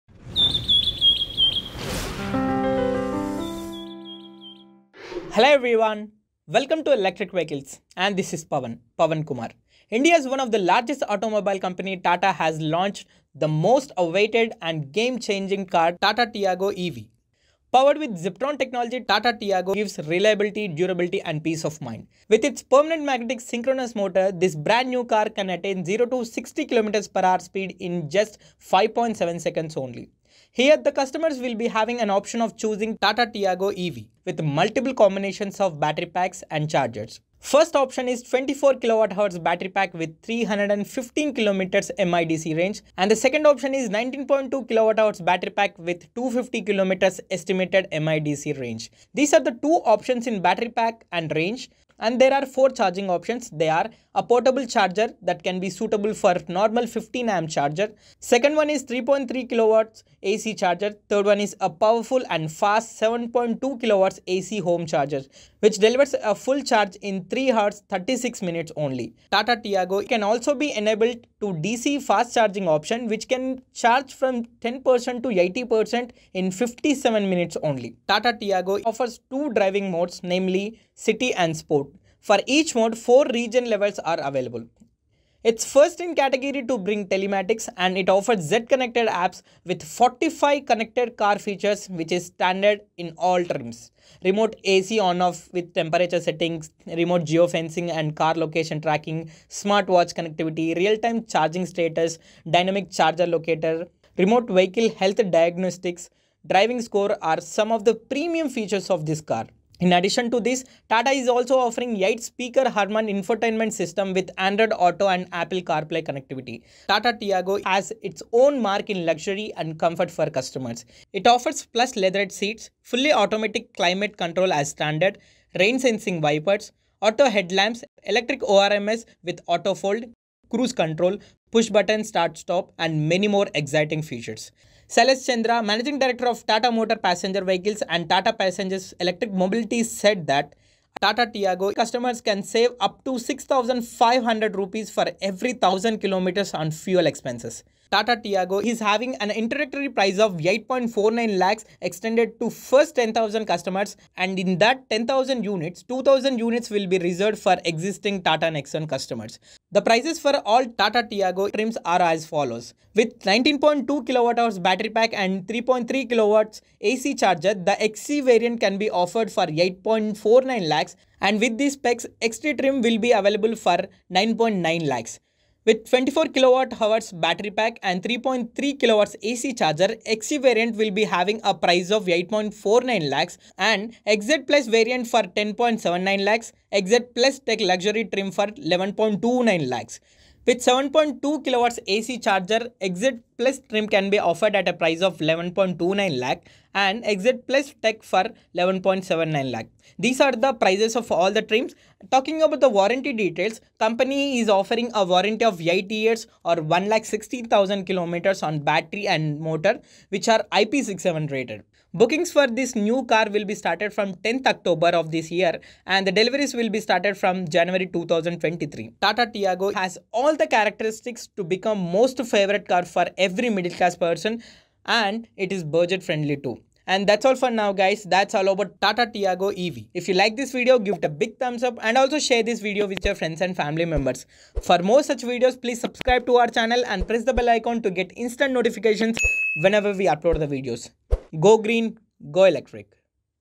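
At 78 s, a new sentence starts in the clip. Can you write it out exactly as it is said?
Tata Tiago offers two driving modes namely city and sport.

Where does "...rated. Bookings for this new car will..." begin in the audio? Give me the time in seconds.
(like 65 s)
211 s.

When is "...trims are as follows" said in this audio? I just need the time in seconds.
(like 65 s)
161 s.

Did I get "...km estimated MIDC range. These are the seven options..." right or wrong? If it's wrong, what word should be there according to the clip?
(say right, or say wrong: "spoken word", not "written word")
wrong: "two", not "seven".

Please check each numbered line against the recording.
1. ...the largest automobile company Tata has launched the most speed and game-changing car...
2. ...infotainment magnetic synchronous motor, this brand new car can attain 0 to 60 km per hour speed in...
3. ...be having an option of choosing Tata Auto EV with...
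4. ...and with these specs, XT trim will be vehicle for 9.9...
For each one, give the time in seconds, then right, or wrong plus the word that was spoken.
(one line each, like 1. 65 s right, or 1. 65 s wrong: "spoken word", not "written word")
1. 10 s wrong: "awaited", not "speed"
2. 22 s wrong: "permanent", not "infotainment"
3. 31 s wrong: "Tiago", not "Auto"
4. 171 s wrong: "available", not "vehicle".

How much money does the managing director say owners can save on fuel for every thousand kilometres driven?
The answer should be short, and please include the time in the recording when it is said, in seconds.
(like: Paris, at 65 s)
6500 rupees, at 143 s.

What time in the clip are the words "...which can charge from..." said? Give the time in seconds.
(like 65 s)
73 s.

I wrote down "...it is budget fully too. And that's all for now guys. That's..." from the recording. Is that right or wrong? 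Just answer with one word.
wrong.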